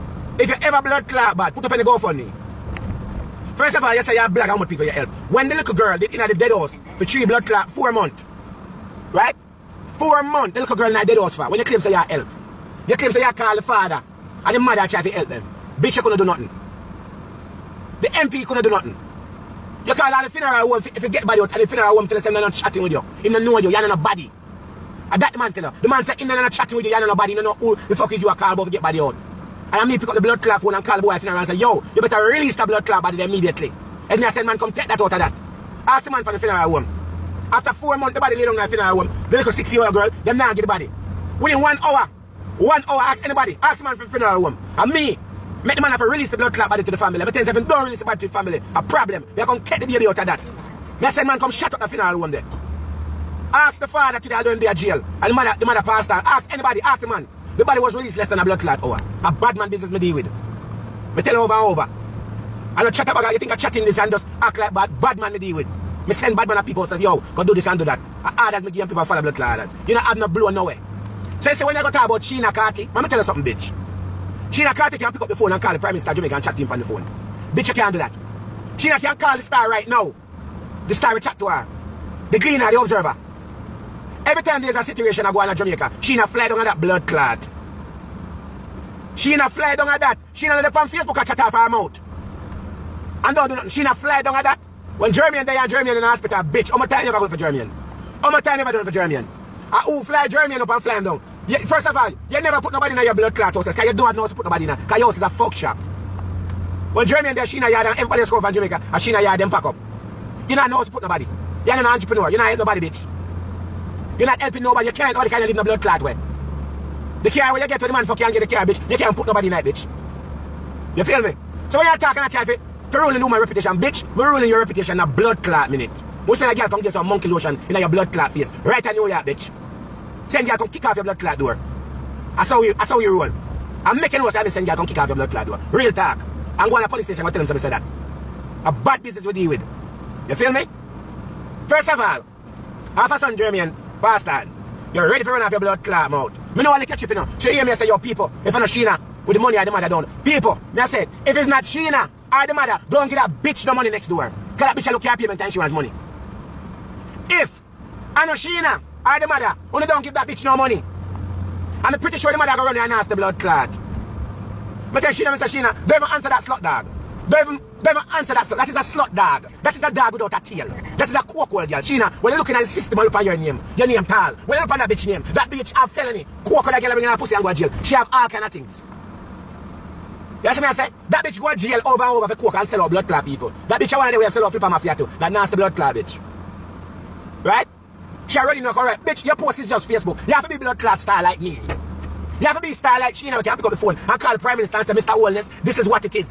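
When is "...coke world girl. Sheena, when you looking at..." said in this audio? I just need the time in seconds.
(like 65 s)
171 s.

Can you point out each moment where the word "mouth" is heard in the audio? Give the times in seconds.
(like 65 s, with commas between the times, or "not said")
91 s, 146 s.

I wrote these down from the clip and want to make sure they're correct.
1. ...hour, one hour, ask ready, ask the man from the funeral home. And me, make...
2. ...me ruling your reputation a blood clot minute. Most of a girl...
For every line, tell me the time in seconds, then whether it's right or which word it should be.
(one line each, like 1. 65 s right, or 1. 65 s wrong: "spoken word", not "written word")
1. 41 s wrong: "anybody", not "ready"
2. 124 s right.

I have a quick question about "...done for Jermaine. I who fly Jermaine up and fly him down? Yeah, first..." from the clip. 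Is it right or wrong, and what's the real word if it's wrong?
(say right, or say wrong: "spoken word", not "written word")
right.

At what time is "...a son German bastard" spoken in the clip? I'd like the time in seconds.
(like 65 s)
143 s.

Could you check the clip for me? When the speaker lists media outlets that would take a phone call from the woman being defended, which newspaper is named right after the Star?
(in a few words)
The Gleaner.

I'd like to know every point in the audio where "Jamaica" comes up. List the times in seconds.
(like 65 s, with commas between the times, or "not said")
76 s, 85 s, 108 s.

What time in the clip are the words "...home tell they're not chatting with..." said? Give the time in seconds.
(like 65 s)
21 s.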